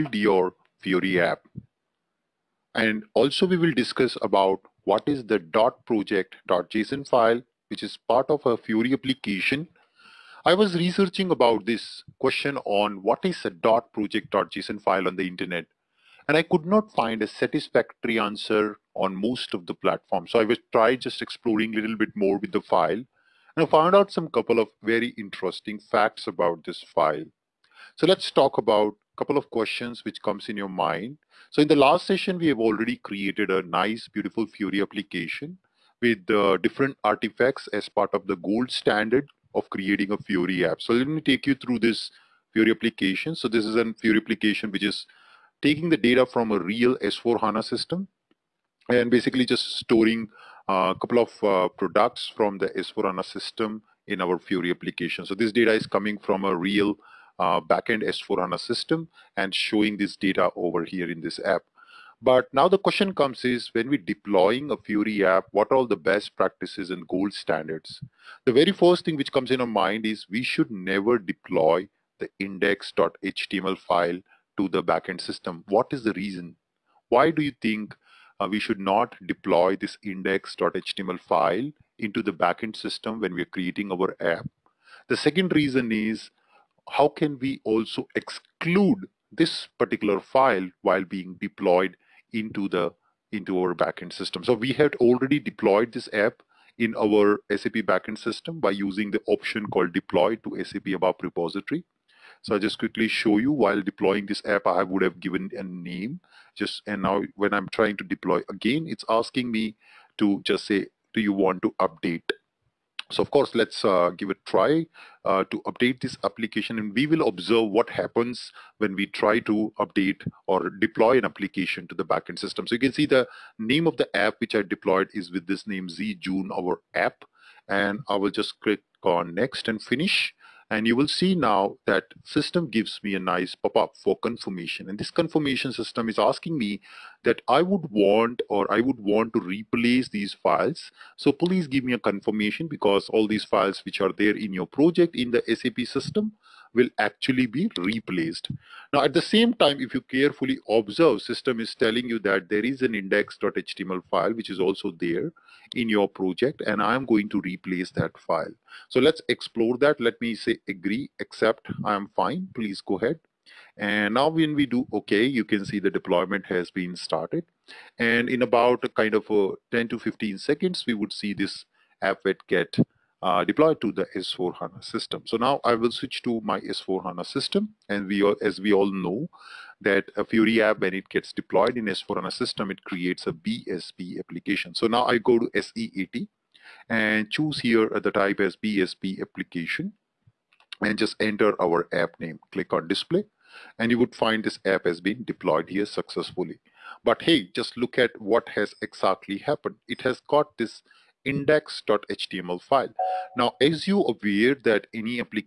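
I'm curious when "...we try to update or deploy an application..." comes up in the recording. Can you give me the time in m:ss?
1:58.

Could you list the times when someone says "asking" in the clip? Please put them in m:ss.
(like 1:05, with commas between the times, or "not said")
1:49, 2:16.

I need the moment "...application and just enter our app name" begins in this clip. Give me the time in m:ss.
3:09.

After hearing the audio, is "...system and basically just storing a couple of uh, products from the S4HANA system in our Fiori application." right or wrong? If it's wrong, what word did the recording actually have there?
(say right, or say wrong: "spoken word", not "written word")
right.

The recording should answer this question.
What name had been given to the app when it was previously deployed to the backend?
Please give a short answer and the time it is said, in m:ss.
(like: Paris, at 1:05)
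Z June, at 2:05.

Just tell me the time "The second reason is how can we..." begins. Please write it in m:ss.
1:25.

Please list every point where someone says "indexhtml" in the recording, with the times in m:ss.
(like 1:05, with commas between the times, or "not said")
1:12, 1:20, 2:32, 3:21.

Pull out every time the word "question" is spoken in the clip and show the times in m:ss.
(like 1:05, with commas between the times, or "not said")
0:12, 0:29, 1:02.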